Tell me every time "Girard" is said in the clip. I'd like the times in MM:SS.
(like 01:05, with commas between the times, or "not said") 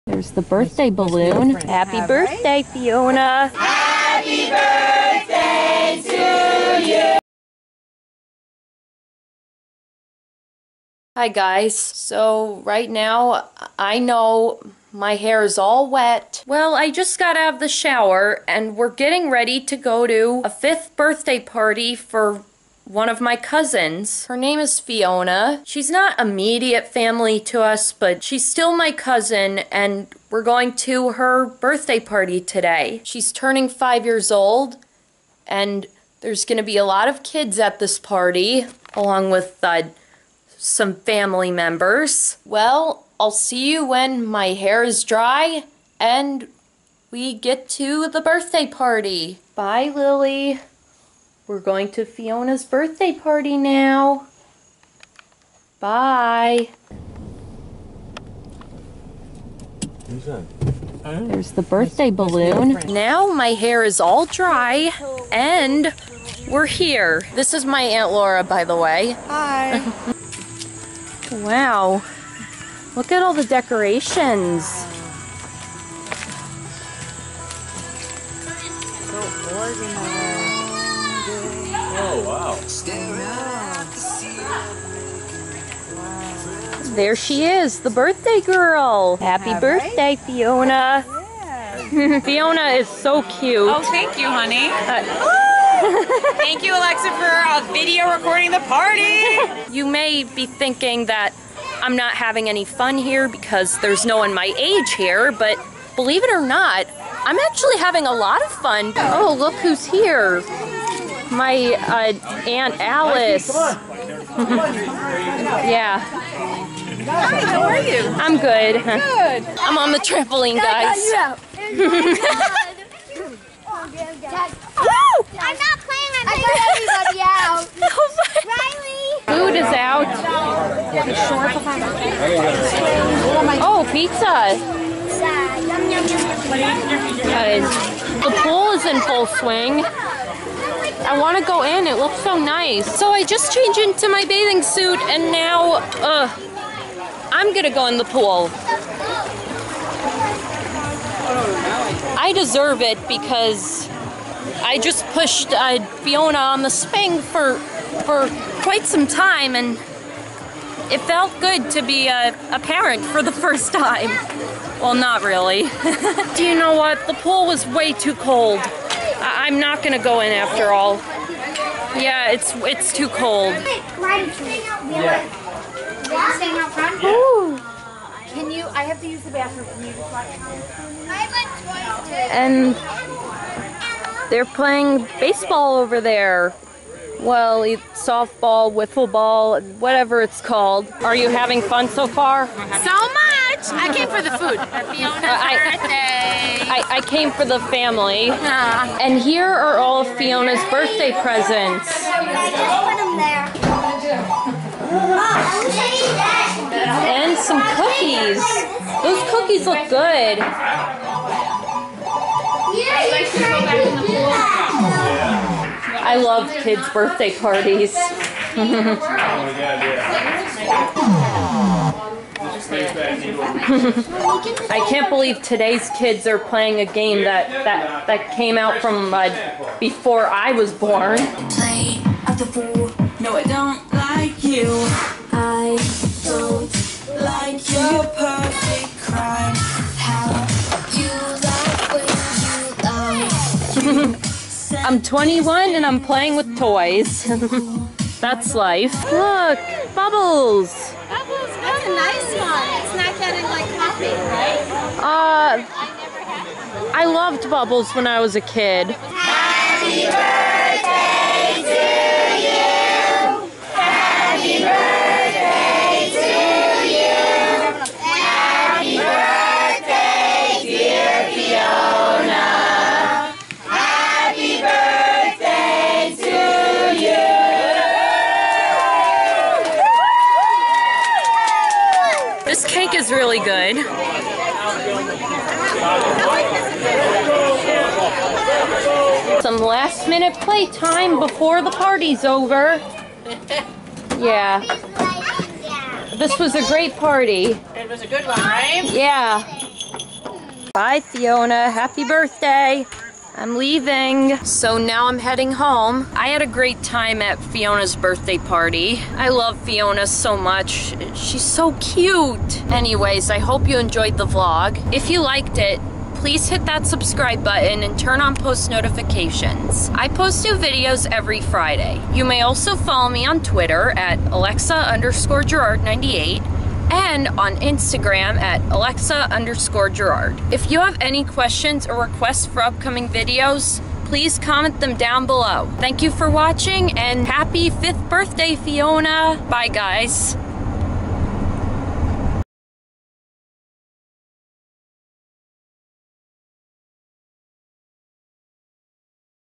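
05:25, 05:29.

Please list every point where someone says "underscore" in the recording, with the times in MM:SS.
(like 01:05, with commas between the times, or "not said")
05:24, 05:29.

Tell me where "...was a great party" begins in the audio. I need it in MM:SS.
04:56.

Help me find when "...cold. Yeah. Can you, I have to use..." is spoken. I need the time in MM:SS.
02:53.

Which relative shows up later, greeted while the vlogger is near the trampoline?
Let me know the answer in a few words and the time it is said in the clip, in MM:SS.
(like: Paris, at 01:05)
Aunt Alice, at 01:52.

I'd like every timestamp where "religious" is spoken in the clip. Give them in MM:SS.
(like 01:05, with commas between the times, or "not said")
not said.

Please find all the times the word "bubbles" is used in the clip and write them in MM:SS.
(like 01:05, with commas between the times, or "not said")
04:09, 04:17.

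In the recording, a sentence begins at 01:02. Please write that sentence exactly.
Now my hair is all dry and we're here.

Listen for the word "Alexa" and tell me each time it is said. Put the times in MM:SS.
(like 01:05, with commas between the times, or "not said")
01:36, 05:24, 05:28.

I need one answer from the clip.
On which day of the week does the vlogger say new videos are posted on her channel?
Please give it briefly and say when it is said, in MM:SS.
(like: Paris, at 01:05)
Friday, at 05:21.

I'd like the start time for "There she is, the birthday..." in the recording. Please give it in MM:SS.
01:26.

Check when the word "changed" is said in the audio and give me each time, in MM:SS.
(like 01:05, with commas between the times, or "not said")
02:23.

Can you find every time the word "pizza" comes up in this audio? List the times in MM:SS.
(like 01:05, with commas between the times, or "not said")
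02:13.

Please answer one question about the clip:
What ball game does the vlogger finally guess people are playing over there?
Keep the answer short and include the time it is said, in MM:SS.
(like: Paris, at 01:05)
Wiffle ball, at 03:08.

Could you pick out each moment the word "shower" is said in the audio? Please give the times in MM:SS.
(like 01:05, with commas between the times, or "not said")
00:17.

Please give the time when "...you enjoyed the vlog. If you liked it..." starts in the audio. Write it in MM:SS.
05:13.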